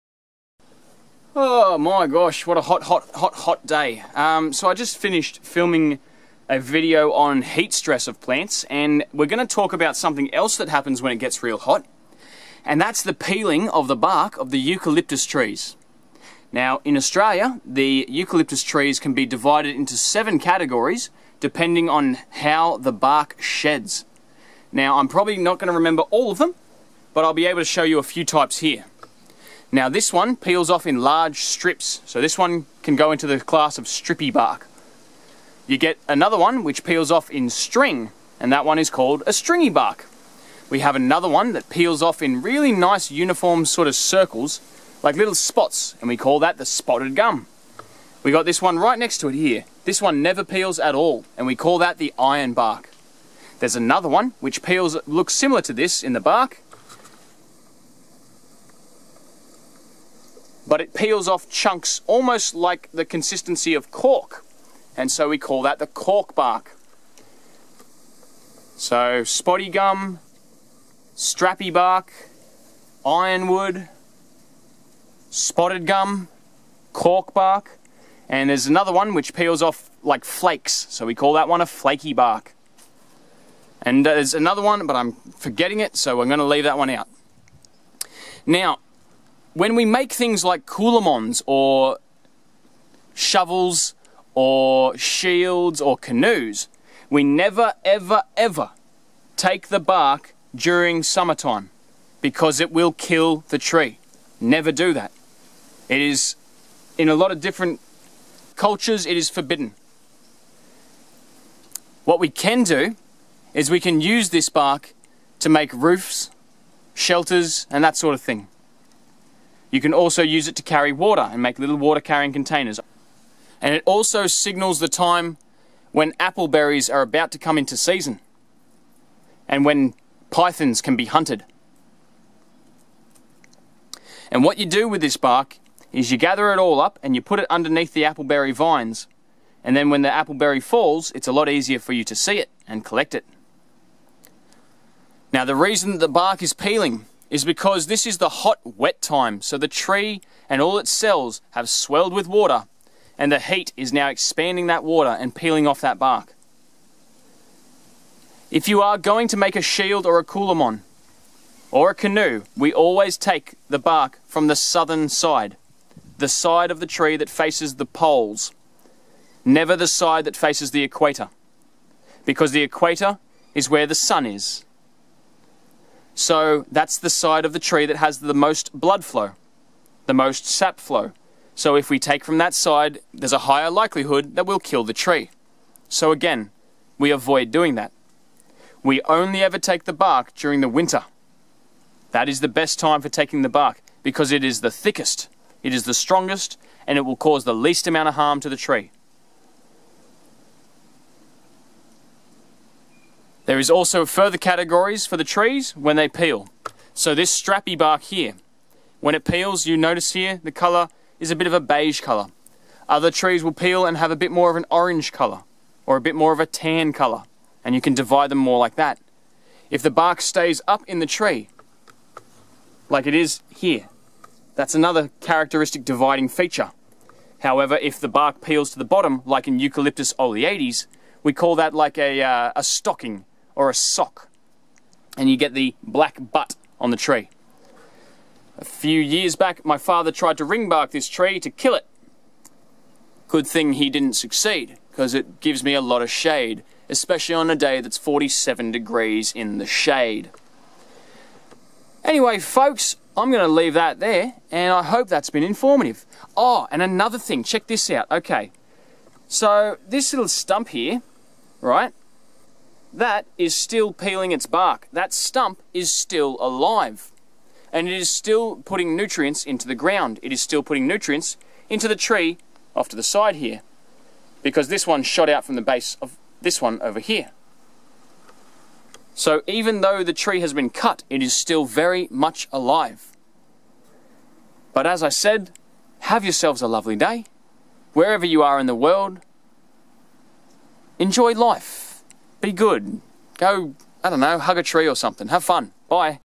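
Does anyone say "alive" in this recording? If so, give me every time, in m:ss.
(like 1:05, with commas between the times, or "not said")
4:26, 4:42.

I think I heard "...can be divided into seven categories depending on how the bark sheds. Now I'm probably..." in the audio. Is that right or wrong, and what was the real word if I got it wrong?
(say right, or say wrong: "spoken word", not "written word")
right.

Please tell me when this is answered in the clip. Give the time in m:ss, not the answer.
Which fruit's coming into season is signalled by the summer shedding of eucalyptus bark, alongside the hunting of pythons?
2:06.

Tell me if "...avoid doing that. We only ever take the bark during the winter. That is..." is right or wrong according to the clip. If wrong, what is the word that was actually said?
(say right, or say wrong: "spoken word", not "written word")
right.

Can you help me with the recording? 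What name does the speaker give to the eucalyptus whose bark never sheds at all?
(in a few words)
Iron bark.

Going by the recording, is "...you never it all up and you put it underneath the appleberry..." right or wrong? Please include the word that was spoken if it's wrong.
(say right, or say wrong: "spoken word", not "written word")
wrong: "gather", not "never".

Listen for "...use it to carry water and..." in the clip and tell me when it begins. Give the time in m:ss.
2:00.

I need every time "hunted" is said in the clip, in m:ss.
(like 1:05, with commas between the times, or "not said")
2:11.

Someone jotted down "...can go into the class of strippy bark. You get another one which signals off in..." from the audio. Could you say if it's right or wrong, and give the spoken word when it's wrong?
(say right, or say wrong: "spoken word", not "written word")
wrong: "peels", not "signals".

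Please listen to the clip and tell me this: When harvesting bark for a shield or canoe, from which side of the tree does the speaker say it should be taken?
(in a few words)
The southern side.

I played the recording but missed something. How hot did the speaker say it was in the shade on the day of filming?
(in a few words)
47 degrees.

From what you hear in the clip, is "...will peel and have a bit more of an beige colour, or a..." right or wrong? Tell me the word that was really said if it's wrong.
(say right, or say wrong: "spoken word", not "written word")
wrong: "orange", not "beige".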